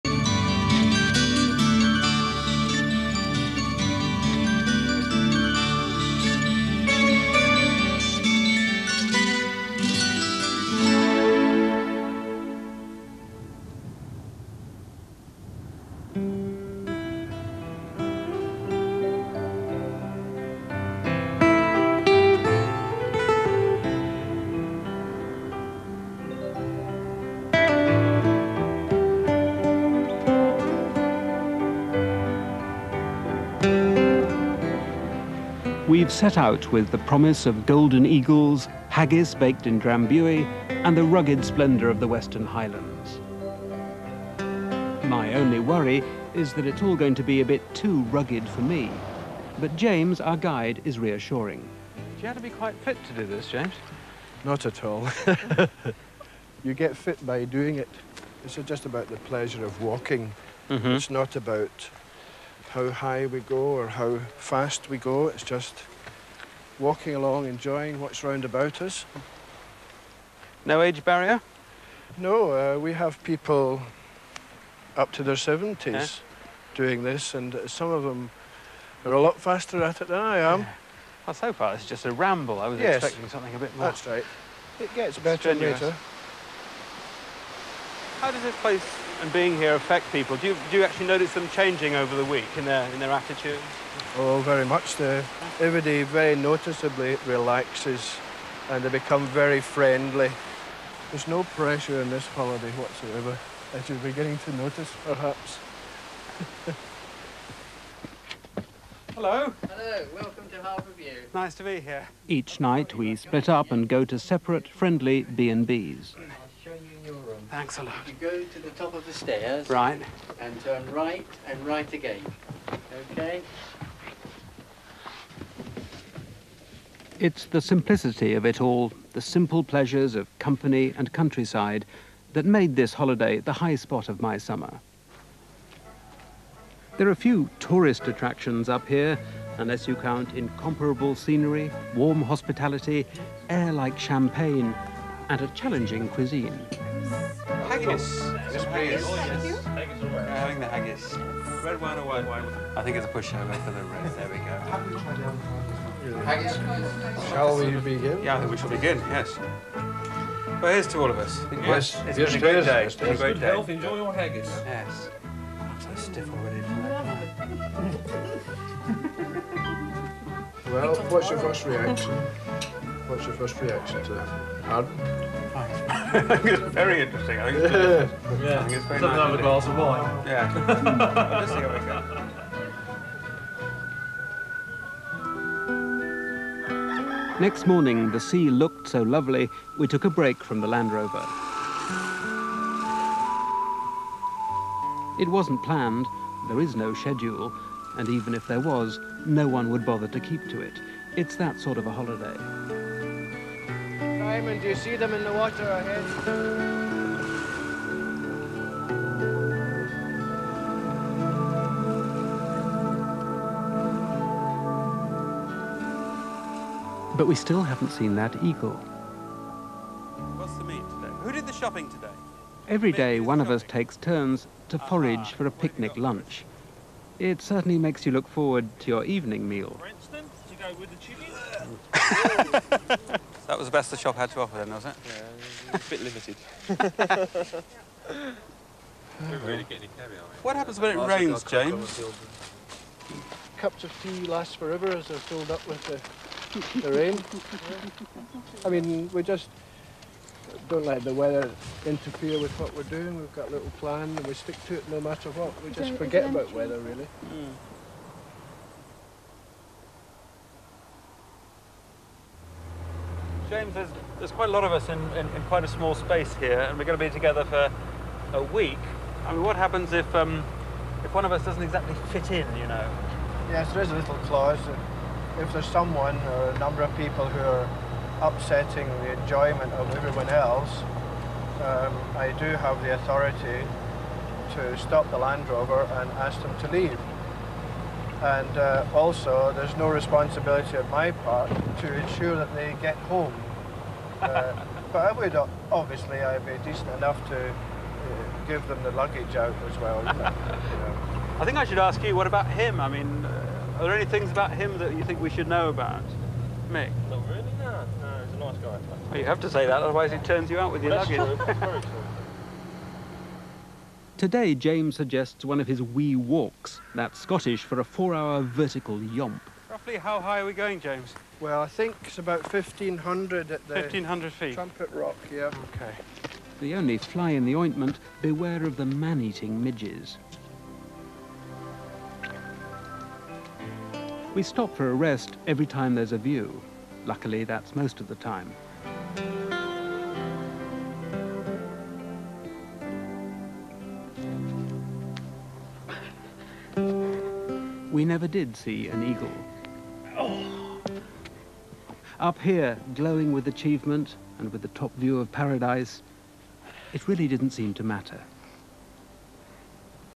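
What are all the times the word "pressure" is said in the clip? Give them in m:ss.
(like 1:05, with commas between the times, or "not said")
1:41.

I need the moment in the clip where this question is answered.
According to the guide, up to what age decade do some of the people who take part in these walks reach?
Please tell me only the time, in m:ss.
1:15.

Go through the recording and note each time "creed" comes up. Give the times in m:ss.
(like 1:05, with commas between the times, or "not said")
not said.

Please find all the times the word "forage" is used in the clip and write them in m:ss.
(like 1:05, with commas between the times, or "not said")
3:44.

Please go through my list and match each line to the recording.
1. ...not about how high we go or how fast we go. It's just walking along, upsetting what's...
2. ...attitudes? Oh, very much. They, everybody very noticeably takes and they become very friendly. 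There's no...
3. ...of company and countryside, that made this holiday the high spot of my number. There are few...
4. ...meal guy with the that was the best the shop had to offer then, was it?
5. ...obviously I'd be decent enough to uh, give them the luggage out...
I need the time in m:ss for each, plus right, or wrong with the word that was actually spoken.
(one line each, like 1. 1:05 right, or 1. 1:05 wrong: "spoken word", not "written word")
1. 1:01 wrong: "enjoying", not "upsetting"
2. 1:33 wrong: "relaxes", not "takes"
3. 2:10 wrong: "summer", not "number"
4. 3:49 right
5. 4:55 right.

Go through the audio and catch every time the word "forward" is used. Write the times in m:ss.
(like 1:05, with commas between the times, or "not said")
3:48.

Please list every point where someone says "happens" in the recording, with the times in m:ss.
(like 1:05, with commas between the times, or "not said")
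4:00, 4:29.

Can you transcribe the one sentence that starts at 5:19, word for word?
Roughly how high are we going, James?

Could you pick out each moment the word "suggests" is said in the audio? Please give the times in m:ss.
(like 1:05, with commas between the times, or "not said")
5:14.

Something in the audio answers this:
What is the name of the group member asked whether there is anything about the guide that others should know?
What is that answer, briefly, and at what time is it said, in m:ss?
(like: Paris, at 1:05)
Mick, at 5:06.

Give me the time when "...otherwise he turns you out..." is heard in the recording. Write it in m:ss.
5:09.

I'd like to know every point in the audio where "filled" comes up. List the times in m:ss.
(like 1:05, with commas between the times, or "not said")
4:05.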